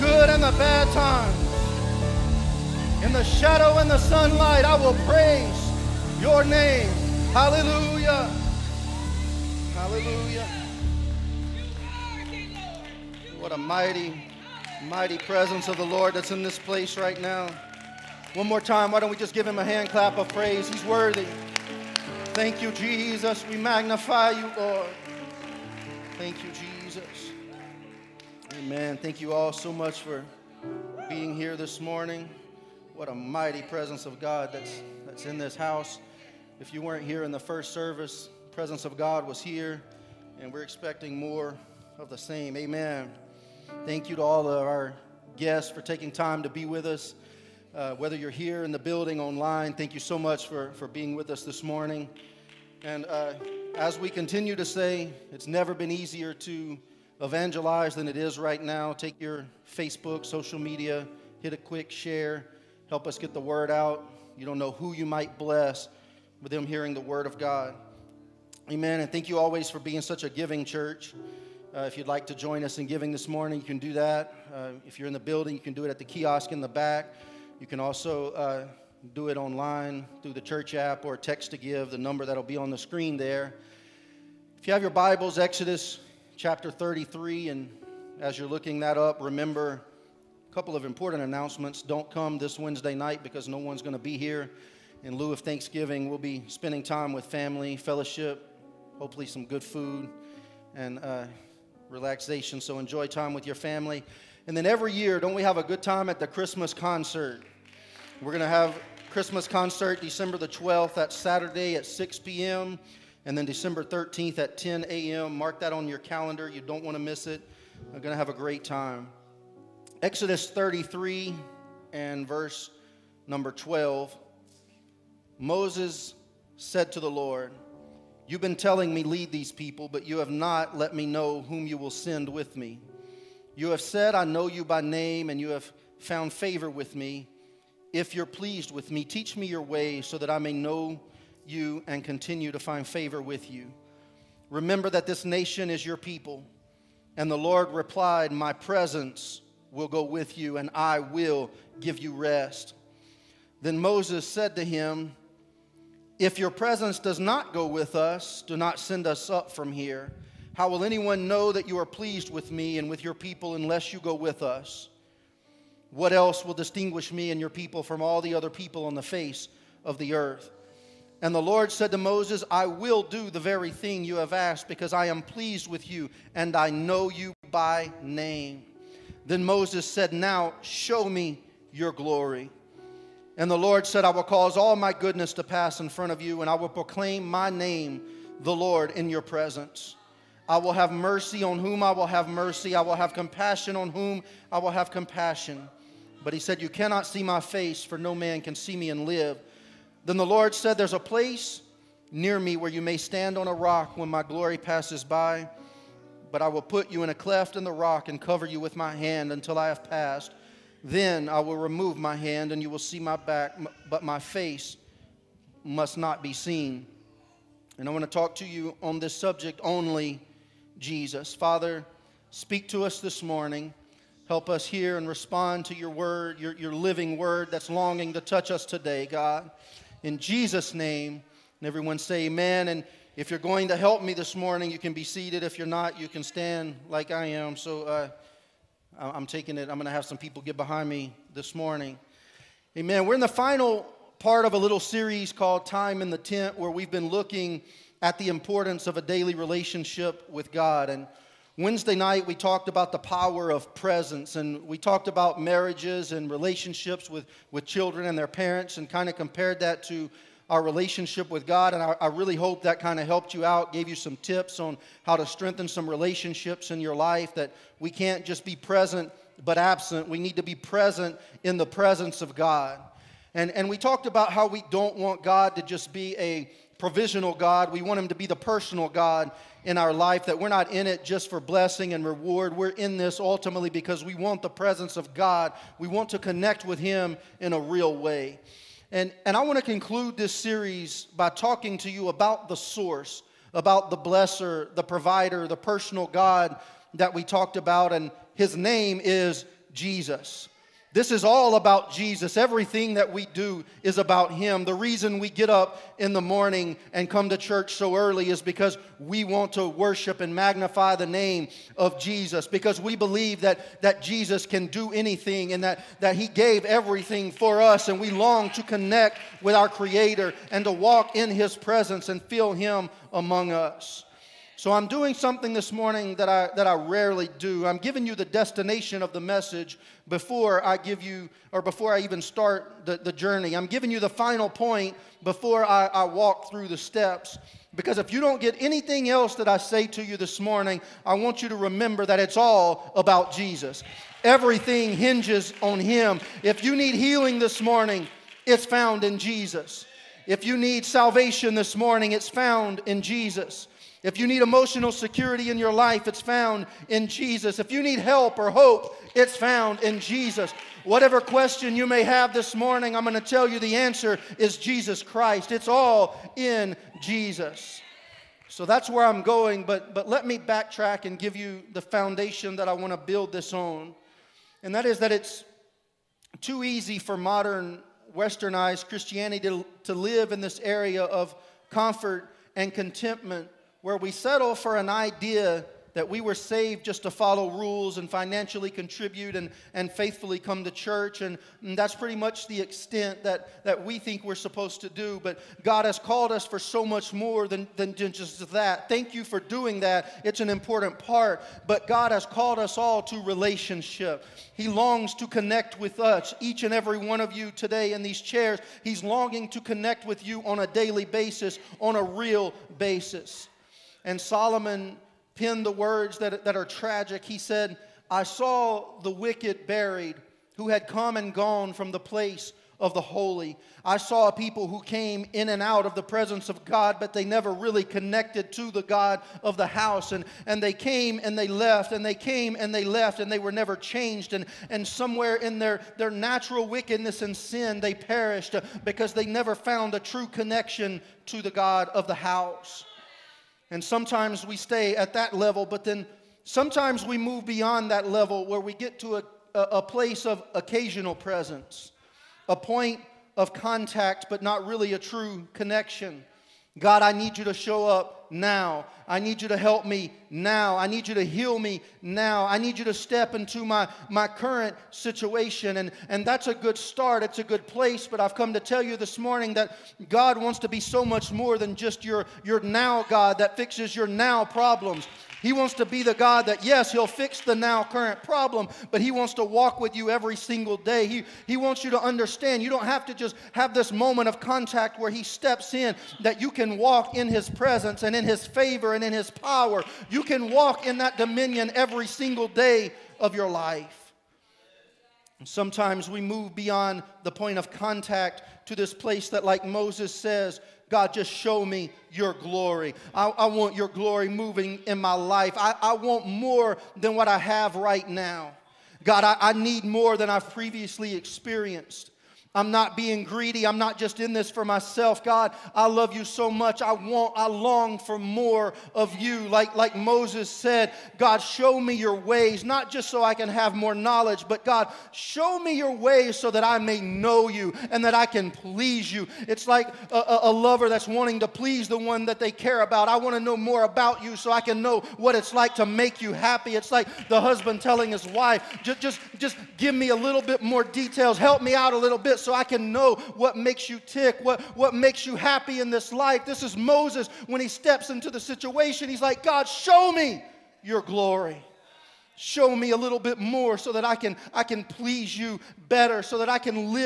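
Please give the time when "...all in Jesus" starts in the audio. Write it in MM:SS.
06:05.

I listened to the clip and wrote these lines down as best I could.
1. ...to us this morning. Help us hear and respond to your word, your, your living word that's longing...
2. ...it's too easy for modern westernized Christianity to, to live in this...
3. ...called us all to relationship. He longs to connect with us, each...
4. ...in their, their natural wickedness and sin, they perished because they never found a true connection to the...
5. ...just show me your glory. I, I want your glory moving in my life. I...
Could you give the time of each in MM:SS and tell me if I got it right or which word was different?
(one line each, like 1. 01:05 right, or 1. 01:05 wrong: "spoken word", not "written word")
1. 03:42 right
2. 06:15 right
3. 06:42 right
4. 07:15 right
5. 08:21 right.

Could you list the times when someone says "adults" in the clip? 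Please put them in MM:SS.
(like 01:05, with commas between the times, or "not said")
not said.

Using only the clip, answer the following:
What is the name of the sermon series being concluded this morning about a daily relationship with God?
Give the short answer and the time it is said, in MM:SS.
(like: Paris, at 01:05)
Time in the Tent, at 04:05.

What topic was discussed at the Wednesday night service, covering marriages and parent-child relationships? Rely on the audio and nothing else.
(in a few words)
the power of presence.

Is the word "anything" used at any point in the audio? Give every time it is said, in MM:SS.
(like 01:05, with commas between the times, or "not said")
05:14, 05:38.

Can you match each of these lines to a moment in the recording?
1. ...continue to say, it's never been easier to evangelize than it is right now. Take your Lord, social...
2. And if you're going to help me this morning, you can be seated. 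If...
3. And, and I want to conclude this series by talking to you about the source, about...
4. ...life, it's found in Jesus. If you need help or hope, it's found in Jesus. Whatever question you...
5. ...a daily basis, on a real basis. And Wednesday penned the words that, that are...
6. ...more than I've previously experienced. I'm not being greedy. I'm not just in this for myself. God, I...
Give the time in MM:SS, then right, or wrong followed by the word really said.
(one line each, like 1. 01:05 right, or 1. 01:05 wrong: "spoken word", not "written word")
1. 00:54 wrong: "Facebook", not "Lord"
2. 03:52 right
3. 04:48 right
4. 05:55 right
5. 06:50 wrong: "Solomon", not "Wednesday"
6. 08:29 right.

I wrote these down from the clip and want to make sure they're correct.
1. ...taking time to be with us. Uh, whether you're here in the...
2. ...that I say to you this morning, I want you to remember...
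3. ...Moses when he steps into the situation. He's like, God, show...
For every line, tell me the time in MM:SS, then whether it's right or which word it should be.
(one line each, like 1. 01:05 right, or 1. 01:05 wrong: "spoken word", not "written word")
1. 00:45 right
2. 05:39 right
3. 09:06 right.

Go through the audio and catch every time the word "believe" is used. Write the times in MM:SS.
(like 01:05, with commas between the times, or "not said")
05:12.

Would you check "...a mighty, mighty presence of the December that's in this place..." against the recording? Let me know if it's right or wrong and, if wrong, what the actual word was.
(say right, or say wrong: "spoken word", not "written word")
wrong: "Lord", not "December".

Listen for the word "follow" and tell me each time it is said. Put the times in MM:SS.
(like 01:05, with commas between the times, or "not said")
06:27.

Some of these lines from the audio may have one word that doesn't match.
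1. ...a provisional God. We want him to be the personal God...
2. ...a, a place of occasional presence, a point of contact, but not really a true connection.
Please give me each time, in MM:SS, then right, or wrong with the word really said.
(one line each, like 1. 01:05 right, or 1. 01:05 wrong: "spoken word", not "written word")
1. 04:36 right
2. 07:29 right.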